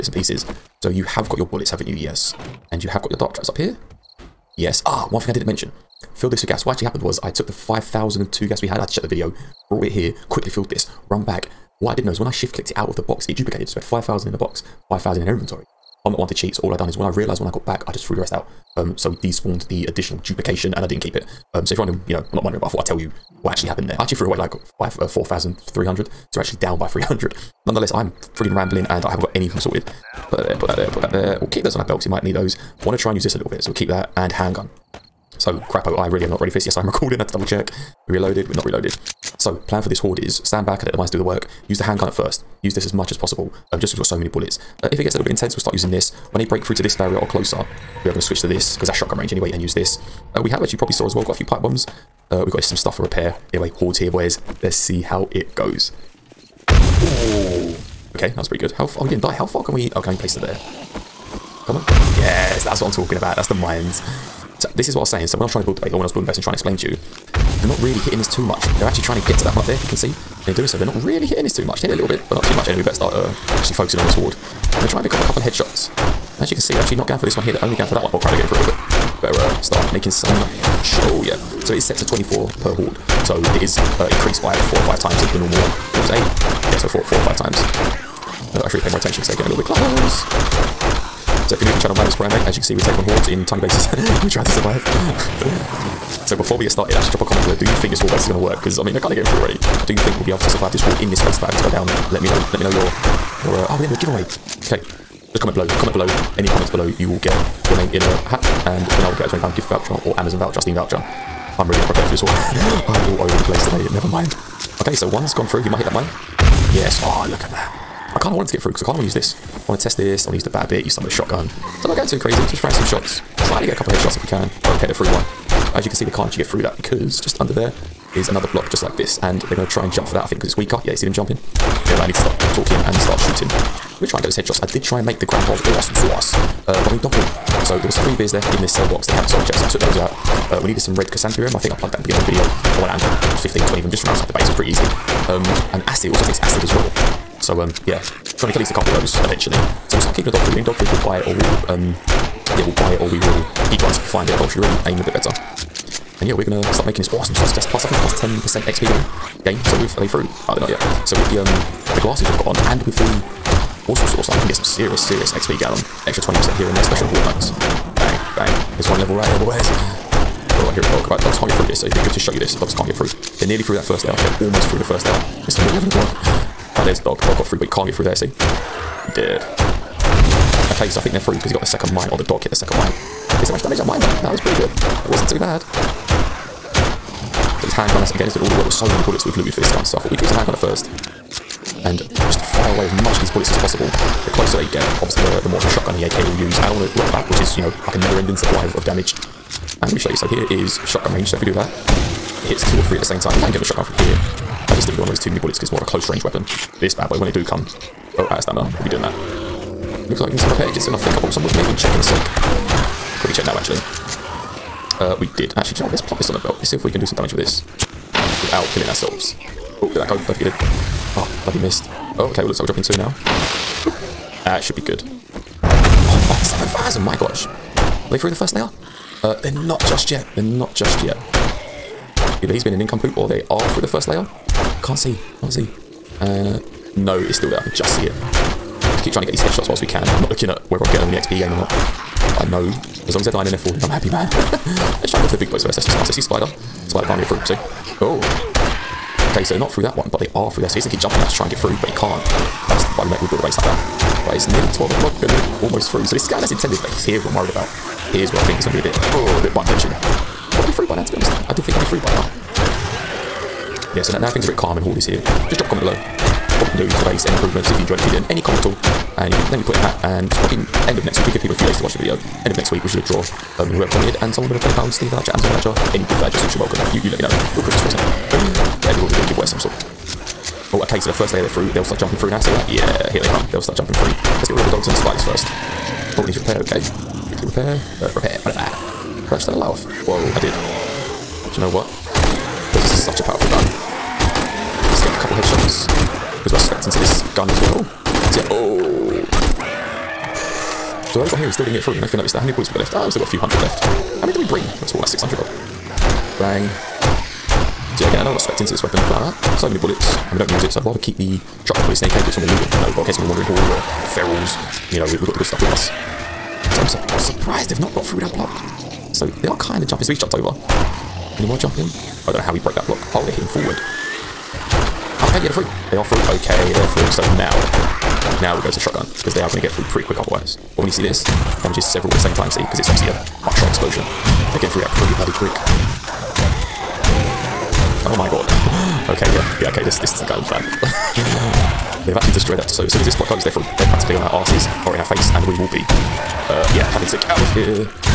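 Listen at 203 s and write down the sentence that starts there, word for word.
You can get the shotgun from here.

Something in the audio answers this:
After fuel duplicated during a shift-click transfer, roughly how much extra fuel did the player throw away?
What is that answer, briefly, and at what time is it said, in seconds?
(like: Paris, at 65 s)
4,300, at 25 s.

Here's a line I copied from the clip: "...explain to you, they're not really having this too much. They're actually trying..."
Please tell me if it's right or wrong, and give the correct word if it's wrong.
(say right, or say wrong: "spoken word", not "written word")
wrong: "hitting", not "having".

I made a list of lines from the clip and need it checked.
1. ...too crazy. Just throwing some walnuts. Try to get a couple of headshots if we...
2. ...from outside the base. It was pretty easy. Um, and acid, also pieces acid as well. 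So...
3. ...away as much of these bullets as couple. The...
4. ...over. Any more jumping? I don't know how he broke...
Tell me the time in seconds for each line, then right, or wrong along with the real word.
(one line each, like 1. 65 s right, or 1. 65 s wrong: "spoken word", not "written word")
1. 122 s wrong: "shots", not "walnuts"
2. 144 s wrong: "takes", not "pieces"
3. 192 s wrong: "possible", not "couple"
4. 320 s right.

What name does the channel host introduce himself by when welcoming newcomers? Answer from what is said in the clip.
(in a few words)
Primate.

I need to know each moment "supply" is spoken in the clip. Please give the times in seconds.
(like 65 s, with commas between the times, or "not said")
198 s.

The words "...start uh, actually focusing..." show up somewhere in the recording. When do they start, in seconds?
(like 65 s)
72 s.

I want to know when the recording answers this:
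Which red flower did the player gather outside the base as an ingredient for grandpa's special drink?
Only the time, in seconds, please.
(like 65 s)
140 s.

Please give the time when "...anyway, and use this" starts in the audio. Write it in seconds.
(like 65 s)
49 s.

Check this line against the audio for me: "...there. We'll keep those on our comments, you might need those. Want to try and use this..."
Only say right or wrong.
wrong.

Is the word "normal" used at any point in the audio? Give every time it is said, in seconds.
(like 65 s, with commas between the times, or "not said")
85 s.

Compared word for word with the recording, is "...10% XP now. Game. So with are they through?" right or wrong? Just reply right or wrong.
right.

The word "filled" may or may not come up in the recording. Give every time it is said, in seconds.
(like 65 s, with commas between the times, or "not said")
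6 s, 10 s.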